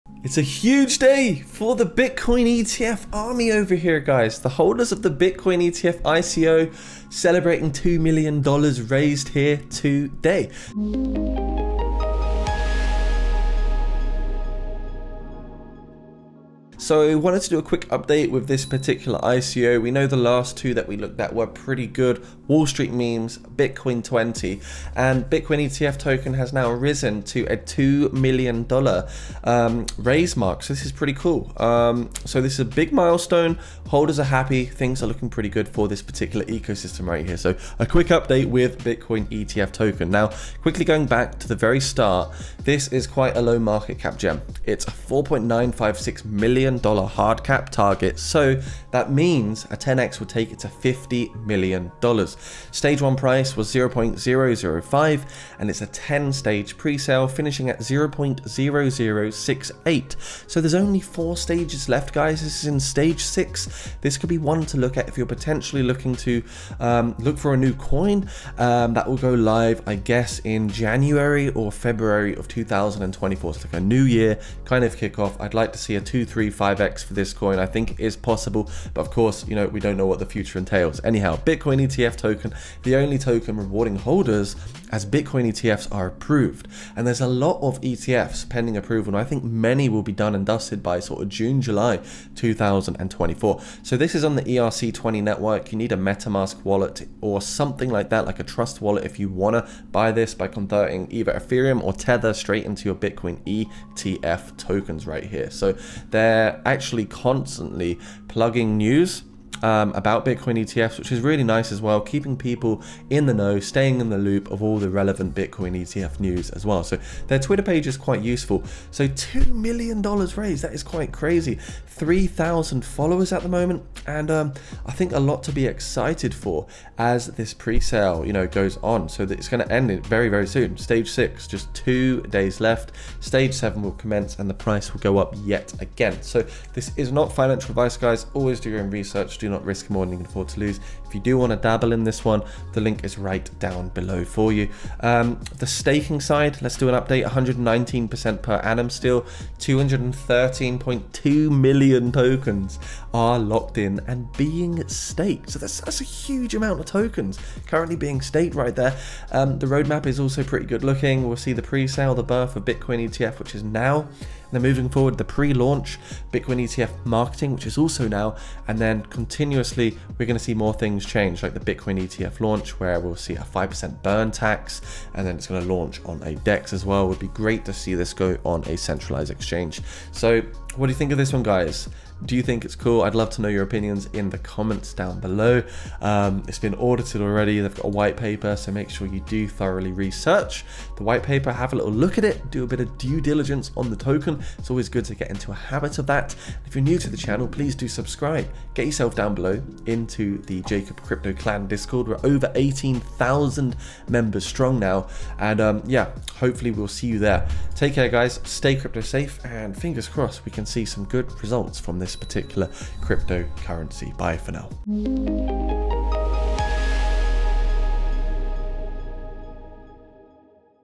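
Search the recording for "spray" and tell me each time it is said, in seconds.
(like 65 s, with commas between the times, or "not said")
not said.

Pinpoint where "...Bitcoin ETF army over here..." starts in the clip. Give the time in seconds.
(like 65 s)
1 s.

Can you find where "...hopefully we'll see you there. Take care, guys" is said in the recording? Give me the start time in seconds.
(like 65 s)
206 s.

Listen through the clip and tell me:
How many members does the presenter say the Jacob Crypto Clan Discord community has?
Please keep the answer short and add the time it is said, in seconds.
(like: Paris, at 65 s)
over 18,000, at 202 s.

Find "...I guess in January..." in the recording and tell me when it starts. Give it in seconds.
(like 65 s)
69 s.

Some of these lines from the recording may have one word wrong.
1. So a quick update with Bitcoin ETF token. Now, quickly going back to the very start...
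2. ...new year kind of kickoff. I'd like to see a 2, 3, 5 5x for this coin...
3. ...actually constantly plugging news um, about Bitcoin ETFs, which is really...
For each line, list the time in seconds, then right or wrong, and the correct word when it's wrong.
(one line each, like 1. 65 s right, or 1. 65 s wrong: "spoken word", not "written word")
1. 37 s right
2. 73 s right
3. 106 s right.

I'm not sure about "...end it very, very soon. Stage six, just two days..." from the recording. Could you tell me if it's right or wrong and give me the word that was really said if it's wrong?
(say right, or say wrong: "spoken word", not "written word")
right.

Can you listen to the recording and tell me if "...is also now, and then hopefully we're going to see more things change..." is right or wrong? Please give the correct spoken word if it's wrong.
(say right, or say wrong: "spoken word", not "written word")
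wrong: "continuously", not "hopefully".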